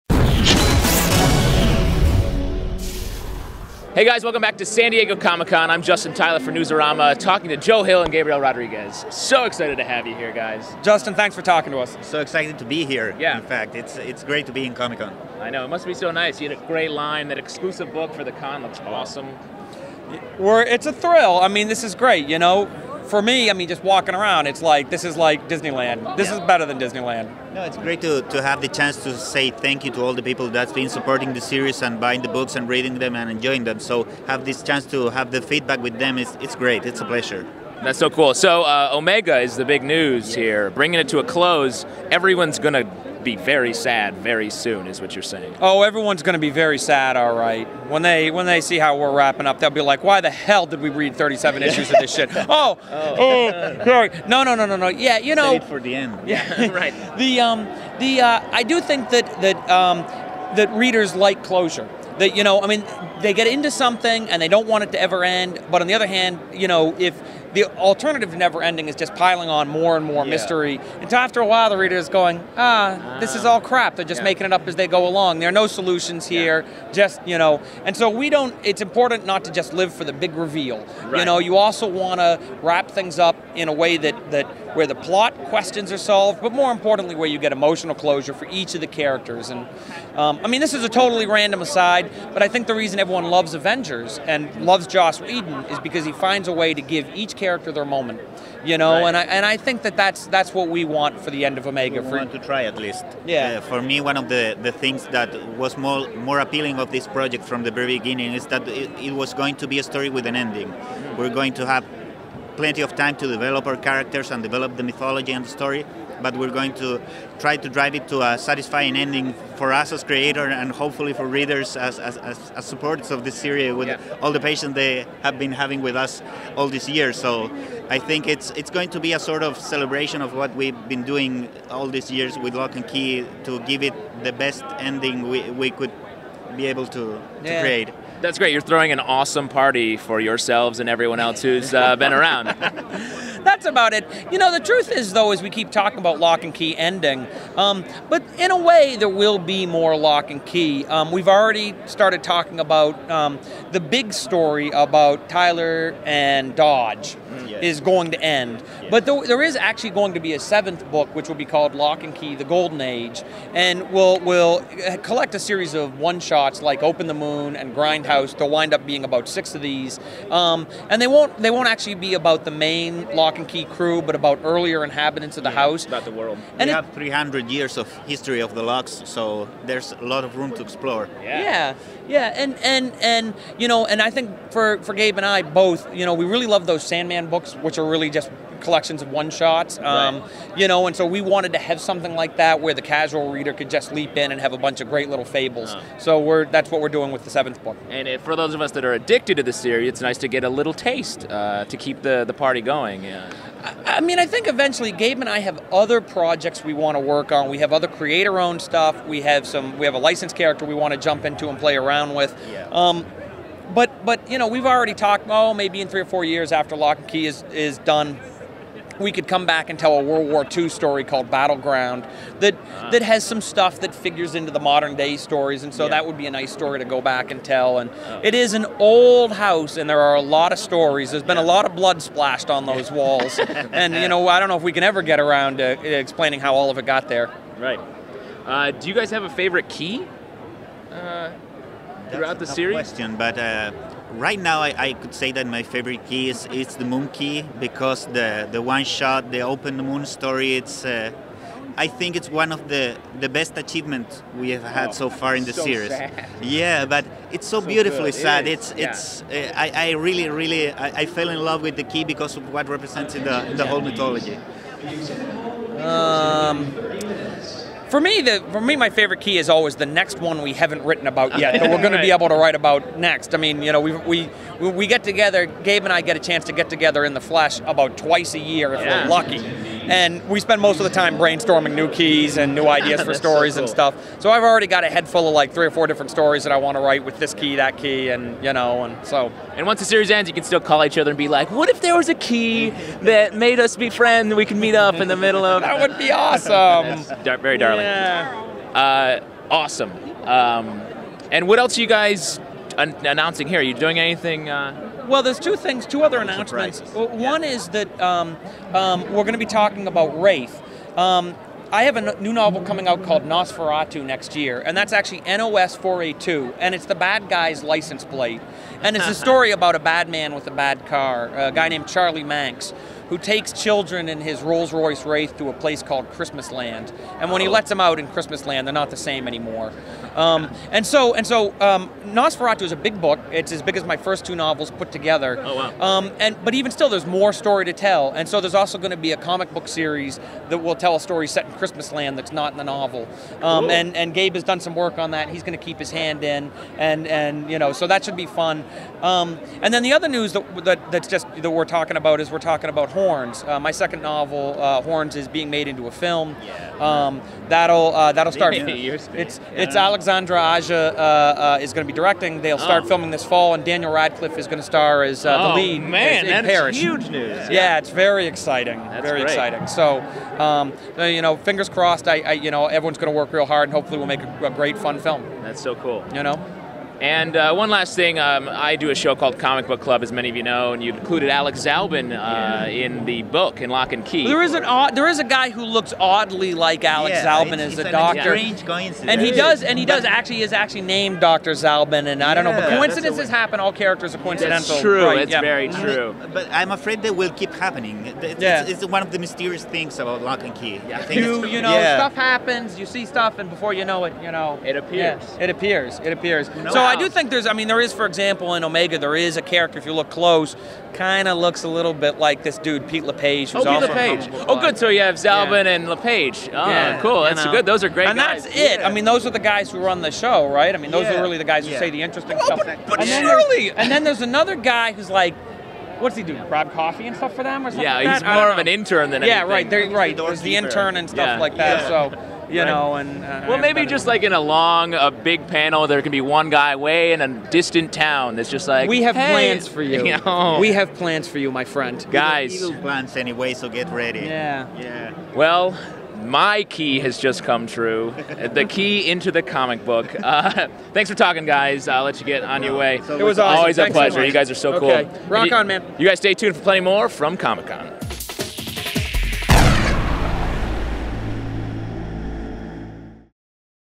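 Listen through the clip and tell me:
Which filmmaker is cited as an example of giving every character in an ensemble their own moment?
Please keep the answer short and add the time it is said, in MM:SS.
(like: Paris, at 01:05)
Joss Whedon, at 01:34.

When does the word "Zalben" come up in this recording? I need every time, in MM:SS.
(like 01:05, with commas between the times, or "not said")
06:21, 06:27, 06:31, 06:55.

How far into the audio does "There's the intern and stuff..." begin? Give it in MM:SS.
07:10.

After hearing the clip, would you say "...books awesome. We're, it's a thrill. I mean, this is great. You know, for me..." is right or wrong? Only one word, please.
wrong.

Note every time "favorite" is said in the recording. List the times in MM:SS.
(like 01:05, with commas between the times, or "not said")
03:59, 04:05, 04:28.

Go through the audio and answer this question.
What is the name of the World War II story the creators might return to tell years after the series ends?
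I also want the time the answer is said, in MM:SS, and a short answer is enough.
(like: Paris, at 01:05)
Battleground, at 03:41.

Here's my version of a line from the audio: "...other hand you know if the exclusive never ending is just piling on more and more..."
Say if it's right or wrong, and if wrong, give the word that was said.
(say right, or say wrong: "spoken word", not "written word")
wrong: "alternative", not "exclusive".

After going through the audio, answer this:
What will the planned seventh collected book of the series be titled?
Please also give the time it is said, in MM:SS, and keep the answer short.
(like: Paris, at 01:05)
Locke and Key: The Golden Age, at 02:41.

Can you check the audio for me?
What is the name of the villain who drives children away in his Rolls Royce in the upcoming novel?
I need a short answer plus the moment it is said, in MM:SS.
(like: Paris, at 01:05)
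Charlie Manx, at 05:21.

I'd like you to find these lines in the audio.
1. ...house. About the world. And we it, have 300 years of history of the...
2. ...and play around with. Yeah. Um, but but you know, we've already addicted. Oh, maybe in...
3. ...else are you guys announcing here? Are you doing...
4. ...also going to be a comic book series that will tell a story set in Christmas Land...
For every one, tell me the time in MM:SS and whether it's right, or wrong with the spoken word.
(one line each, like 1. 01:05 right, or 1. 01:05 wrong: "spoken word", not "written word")
1. 02:55 right
2. 03:31 wrong: "talked", not "addicted"
3. 05:01 right
4. 05:38 right.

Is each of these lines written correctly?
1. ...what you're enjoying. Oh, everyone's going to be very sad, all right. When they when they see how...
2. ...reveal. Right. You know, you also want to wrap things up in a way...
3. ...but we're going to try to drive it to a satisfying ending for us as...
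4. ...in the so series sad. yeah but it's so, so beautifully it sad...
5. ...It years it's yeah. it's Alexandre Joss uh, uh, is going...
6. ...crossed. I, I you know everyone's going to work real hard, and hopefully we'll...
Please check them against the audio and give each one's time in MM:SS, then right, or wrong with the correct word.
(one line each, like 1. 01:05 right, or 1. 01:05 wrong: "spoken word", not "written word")
1. 00:45 wrong: "saying", not "enjoying"
2. 01:20 right
3. 01:56 right
4. 04:15 right
5. 05:58 wrong: "Aja", not "Joss"
6. 06:11 right.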